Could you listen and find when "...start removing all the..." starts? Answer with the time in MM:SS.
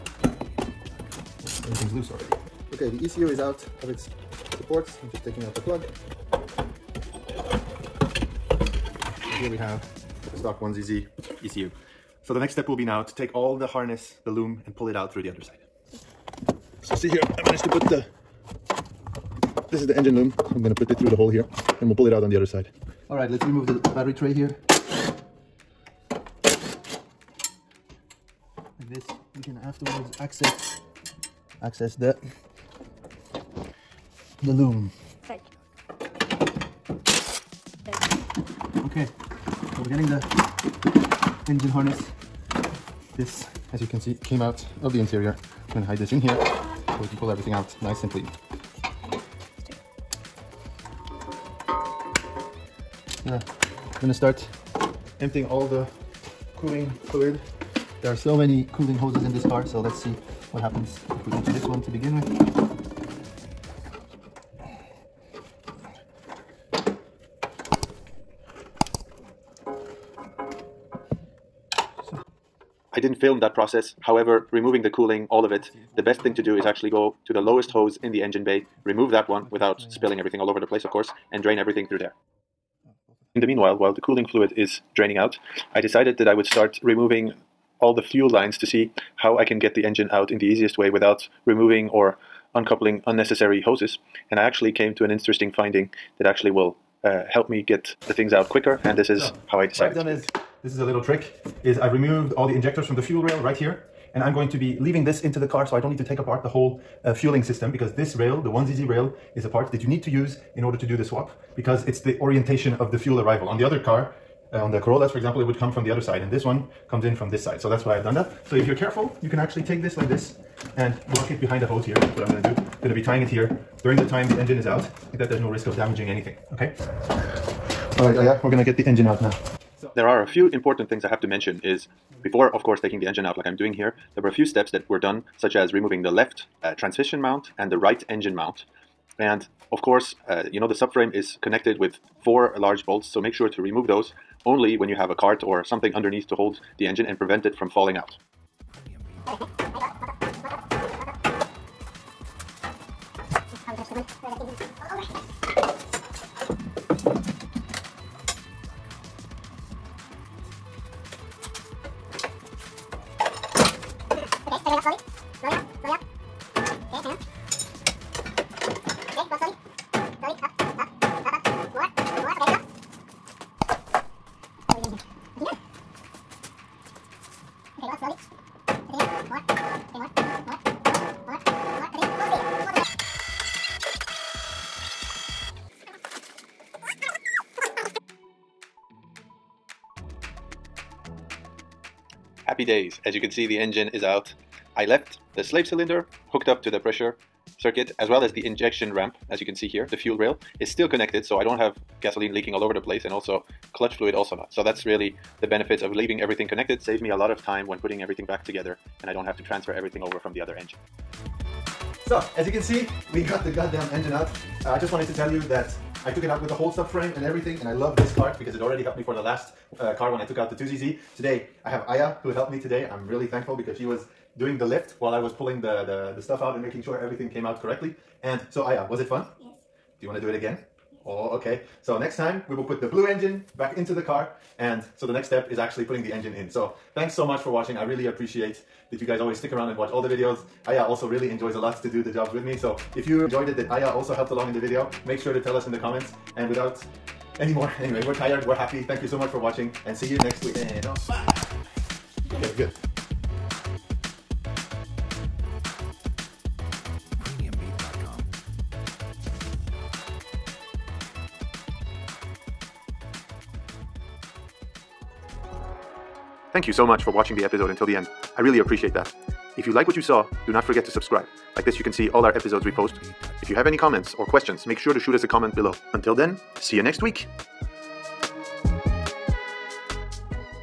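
01:26.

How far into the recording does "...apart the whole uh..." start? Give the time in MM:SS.
01:46.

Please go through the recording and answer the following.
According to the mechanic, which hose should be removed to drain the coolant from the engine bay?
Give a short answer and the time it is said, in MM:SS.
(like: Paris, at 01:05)
The lowest hose, at 01:17.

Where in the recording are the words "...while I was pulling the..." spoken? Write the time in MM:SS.
03:44.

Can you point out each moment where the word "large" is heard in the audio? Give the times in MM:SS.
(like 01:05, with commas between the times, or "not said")
02:22.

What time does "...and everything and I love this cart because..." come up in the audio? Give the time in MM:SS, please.
03:37.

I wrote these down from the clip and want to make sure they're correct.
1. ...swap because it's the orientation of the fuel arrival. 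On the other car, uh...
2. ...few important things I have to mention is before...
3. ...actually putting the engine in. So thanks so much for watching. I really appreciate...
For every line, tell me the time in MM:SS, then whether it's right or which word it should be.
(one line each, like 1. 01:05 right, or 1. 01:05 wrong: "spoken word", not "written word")
1. 01:51 right
2. 02:10 right
3. 03:55 right.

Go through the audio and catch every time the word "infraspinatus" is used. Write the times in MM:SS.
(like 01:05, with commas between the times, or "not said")
not said.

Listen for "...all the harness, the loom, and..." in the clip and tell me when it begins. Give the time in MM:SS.
00:13.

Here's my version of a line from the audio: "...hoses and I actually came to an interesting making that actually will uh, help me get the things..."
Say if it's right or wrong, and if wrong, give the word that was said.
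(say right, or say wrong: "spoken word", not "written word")
wrong: "finding", not "making".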